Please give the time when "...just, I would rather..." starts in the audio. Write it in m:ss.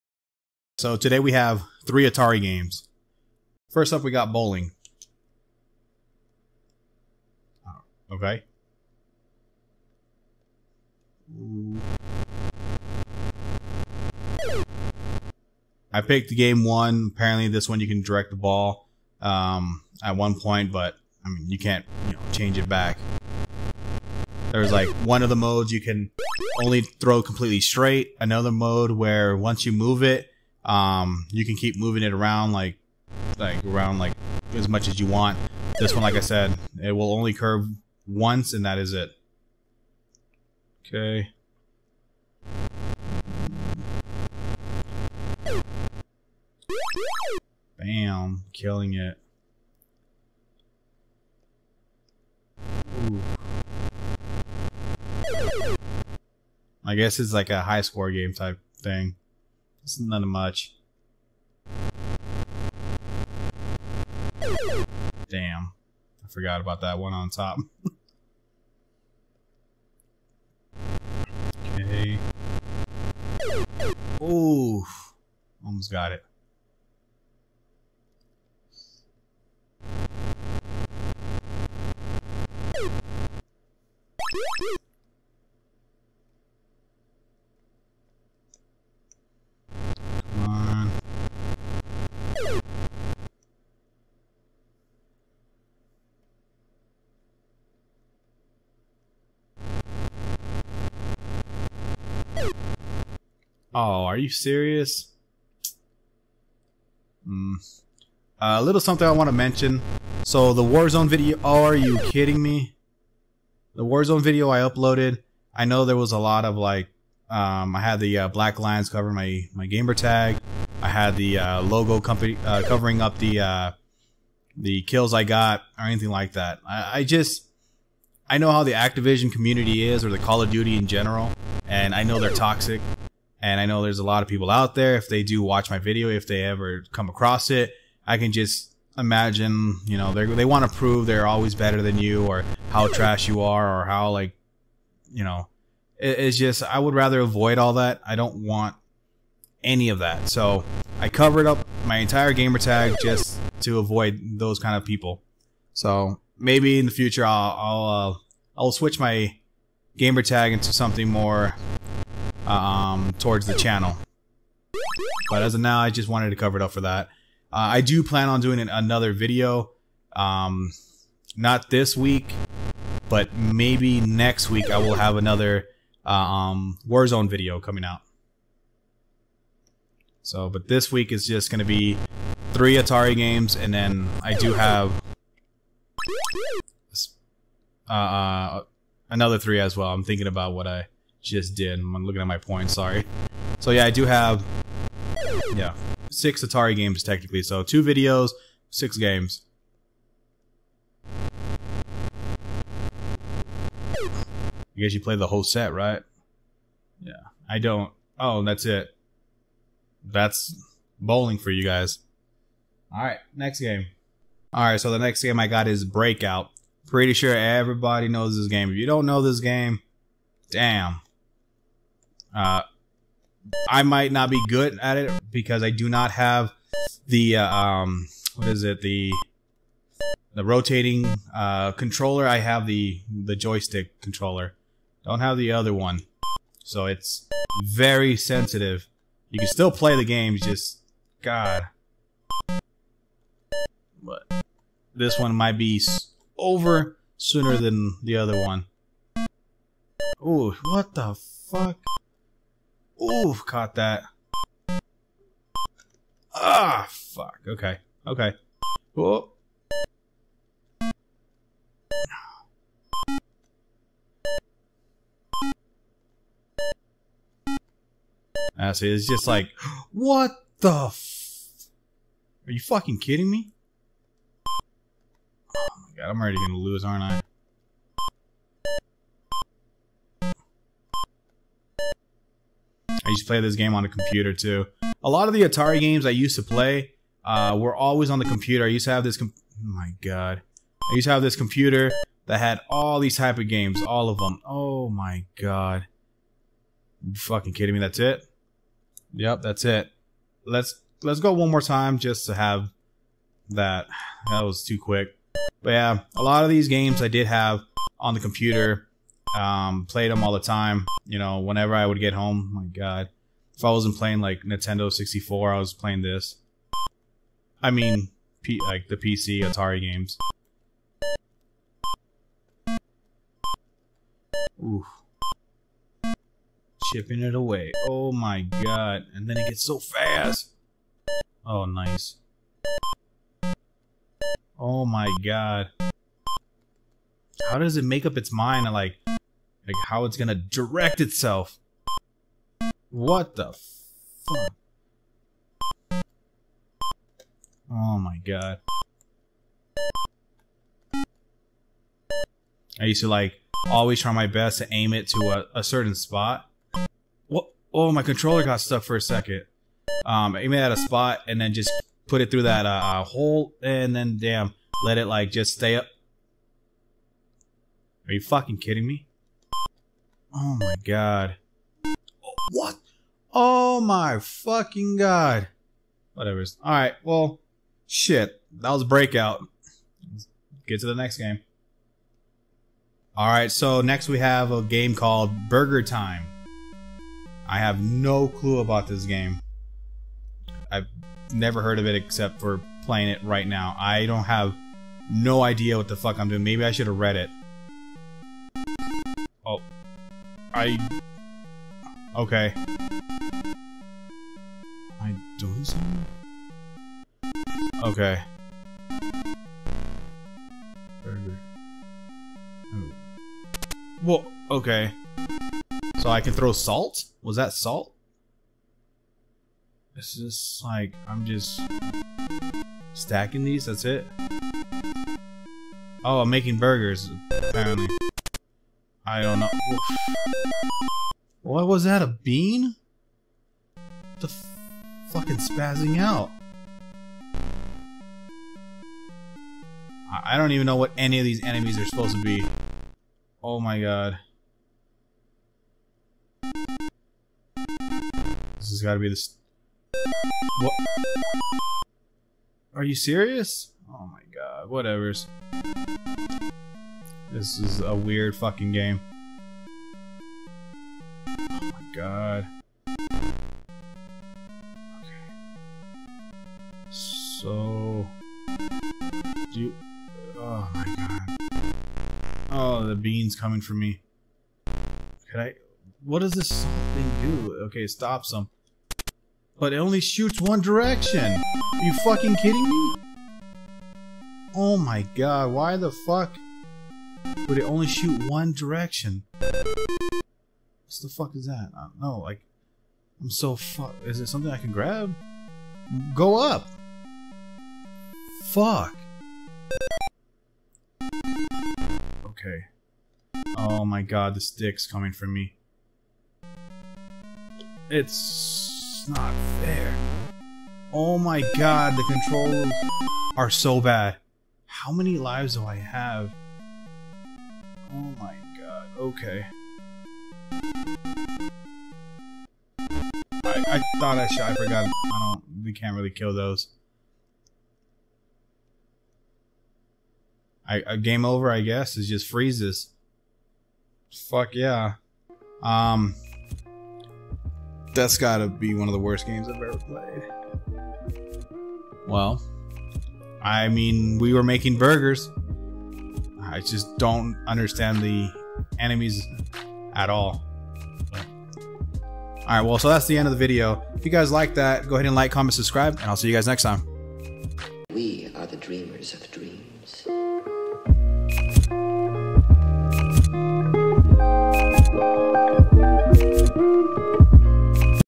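2:26.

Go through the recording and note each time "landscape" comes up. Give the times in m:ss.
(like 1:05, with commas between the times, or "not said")
not said.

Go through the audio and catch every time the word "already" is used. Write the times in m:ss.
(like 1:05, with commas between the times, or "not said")
4:36.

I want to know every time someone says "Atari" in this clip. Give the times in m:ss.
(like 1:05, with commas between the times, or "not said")
0:02, 3:02, 3:16, 4:45, 5:19.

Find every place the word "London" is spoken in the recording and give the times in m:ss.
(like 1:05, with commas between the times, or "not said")
not said.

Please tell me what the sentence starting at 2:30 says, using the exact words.
So I covered up my entire gamertag just to avoid those kind of people.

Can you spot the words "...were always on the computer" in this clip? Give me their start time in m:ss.
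4:47.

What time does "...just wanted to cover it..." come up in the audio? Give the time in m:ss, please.
2:45.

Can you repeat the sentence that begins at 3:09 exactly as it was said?
I'm thinking about what I just did.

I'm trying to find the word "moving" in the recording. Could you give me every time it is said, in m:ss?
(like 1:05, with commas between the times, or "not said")
0:31.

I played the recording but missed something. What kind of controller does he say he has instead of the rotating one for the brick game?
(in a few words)
joystick controller.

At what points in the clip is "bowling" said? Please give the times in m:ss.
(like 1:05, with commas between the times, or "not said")
0:04, 3:30.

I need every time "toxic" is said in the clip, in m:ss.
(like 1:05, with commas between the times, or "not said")
2:12.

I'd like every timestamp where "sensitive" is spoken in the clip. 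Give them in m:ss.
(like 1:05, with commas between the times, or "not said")
3:58.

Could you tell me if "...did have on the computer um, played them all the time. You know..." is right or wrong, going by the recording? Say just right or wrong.
right.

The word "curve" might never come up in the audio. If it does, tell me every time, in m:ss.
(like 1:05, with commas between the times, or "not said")
0:37.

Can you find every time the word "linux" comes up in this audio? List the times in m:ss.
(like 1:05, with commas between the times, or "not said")
not said.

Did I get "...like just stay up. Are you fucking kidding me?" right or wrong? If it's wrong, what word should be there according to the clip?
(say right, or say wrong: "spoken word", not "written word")
right.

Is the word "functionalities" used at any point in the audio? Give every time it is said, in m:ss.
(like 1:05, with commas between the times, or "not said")
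not said.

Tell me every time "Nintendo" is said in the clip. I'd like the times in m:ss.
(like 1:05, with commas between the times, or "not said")
5:14.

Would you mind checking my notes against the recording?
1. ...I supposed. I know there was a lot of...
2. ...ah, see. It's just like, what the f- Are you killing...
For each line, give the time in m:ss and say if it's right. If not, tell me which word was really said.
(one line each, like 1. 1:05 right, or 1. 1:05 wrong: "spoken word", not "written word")
1. 1:54 wrong: "uploaded", not "supposed"
2. 4:28 wrong: "fucking", not "killing".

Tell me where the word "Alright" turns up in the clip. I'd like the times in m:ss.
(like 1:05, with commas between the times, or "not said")
6:16, 6:23.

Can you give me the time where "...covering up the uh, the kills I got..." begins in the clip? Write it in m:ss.
2:02.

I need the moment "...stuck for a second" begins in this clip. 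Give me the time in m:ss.
5:58.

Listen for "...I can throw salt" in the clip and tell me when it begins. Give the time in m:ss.
6:56.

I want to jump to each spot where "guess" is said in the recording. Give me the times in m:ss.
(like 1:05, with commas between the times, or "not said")
0:56, 3:24, 8:51.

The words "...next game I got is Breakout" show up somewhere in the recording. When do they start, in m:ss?
3:34.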